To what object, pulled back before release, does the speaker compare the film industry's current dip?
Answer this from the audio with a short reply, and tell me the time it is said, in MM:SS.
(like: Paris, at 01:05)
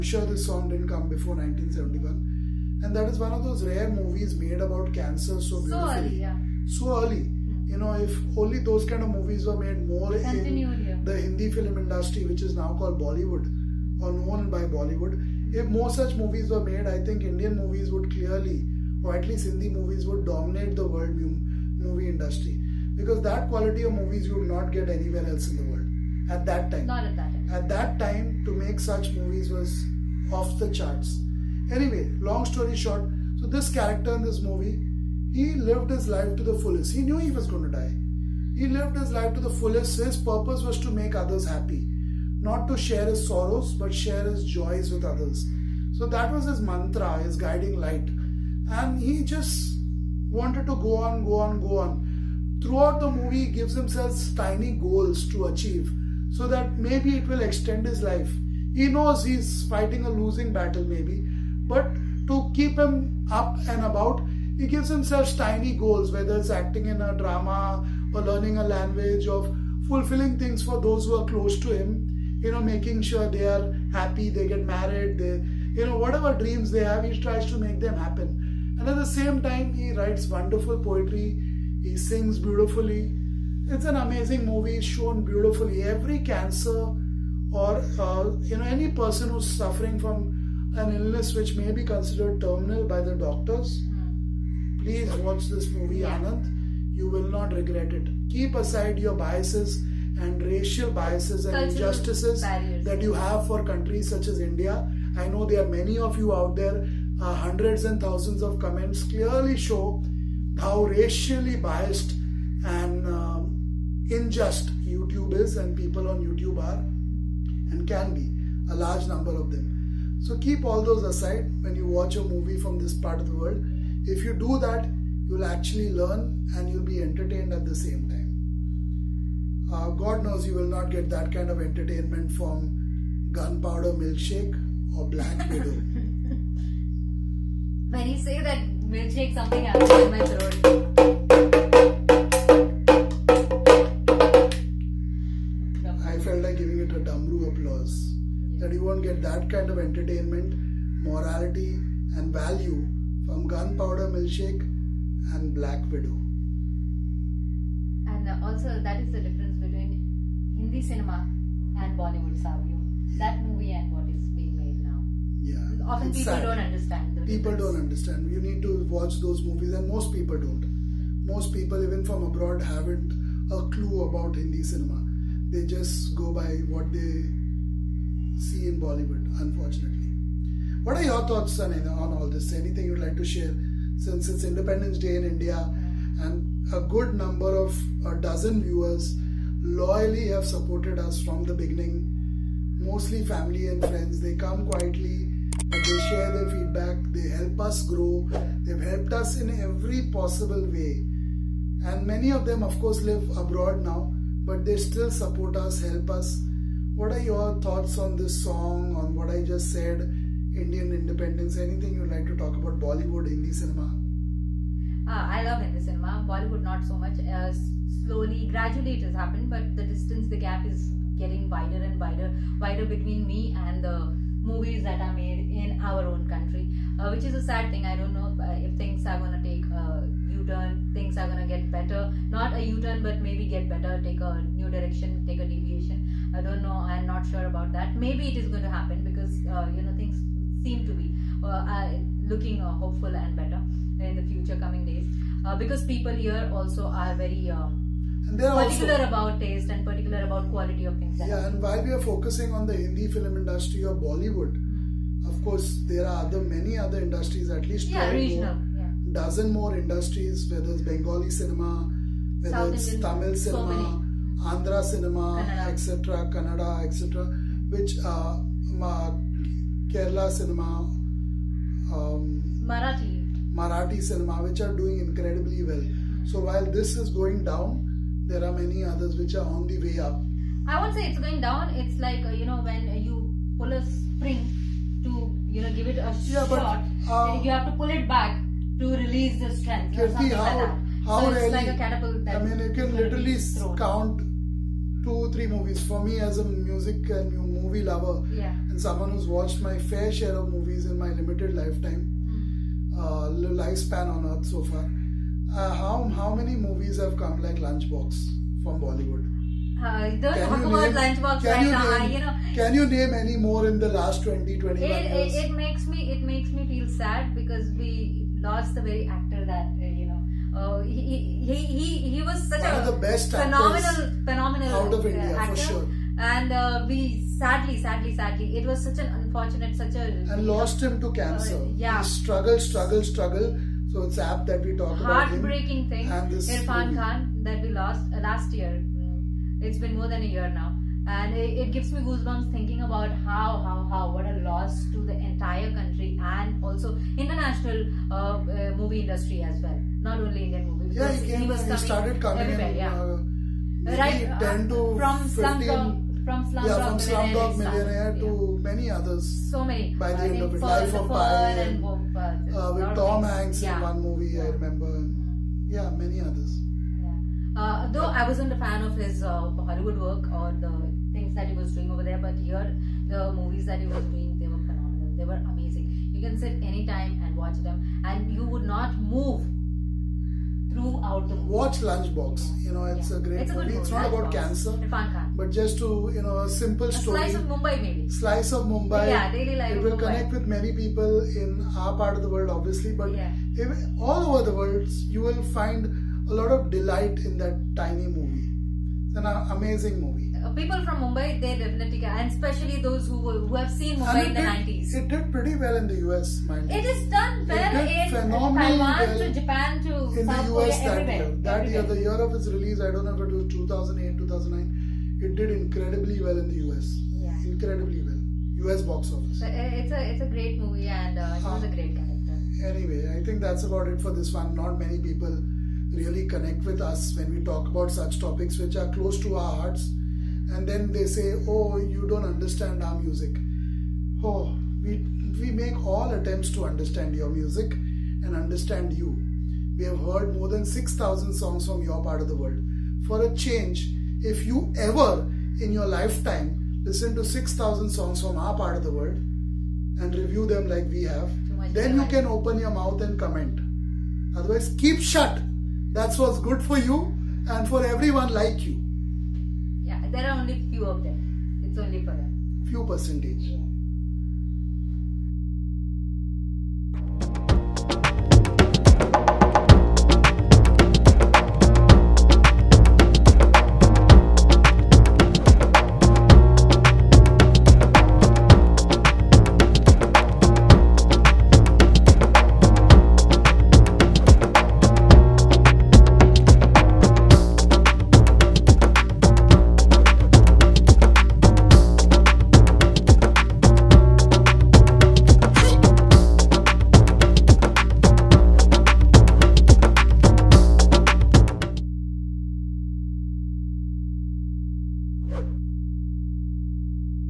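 catapult, at 04:51.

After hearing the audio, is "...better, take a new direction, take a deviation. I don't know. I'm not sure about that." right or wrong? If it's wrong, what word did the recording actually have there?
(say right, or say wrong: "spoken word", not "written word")
right.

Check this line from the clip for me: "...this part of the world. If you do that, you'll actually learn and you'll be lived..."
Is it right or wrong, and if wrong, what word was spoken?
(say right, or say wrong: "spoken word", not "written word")
wrong: "entertained", not "lived".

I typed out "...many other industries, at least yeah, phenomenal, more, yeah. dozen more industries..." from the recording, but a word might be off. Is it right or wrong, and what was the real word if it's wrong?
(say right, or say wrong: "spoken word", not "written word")
wrong: "regional", not "phenomenal".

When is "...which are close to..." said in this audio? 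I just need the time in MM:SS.
07:08.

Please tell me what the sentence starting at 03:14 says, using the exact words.
They come quietly, they share their feedback, they help us grow, they've helped us in every possible way.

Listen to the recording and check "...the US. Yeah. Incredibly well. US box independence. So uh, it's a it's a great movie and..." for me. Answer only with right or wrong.
wrong.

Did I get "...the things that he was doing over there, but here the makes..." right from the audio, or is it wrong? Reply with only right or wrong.
wrong.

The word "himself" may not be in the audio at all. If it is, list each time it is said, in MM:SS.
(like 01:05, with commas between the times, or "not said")
00:53, 01:04.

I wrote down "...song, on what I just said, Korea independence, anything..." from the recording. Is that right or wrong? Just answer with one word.
wrong.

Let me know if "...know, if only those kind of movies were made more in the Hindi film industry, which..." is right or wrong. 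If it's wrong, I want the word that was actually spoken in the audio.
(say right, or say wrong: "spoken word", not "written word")
right.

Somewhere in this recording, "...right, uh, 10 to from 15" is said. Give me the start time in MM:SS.
05:53.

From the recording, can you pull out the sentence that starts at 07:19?
We have heard more than 6,000 songs from your part of the world.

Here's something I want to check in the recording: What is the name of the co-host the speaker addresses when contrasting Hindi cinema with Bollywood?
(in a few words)
Savio.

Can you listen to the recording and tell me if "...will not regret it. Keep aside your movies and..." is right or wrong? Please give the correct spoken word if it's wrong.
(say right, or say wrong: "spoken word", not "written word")
wrong: "biases", not "movies".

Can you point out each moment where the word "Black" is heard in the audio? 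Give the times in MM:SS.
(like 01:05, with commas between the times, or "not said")
02:15, 02:35.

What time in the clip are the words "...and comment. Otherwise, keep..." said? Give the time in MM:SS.
07:33.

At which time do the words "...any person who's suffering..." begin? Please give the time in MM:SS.
01:28.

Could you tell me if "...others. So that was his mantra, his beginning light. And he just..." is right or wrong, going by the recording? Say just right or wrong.
wrong.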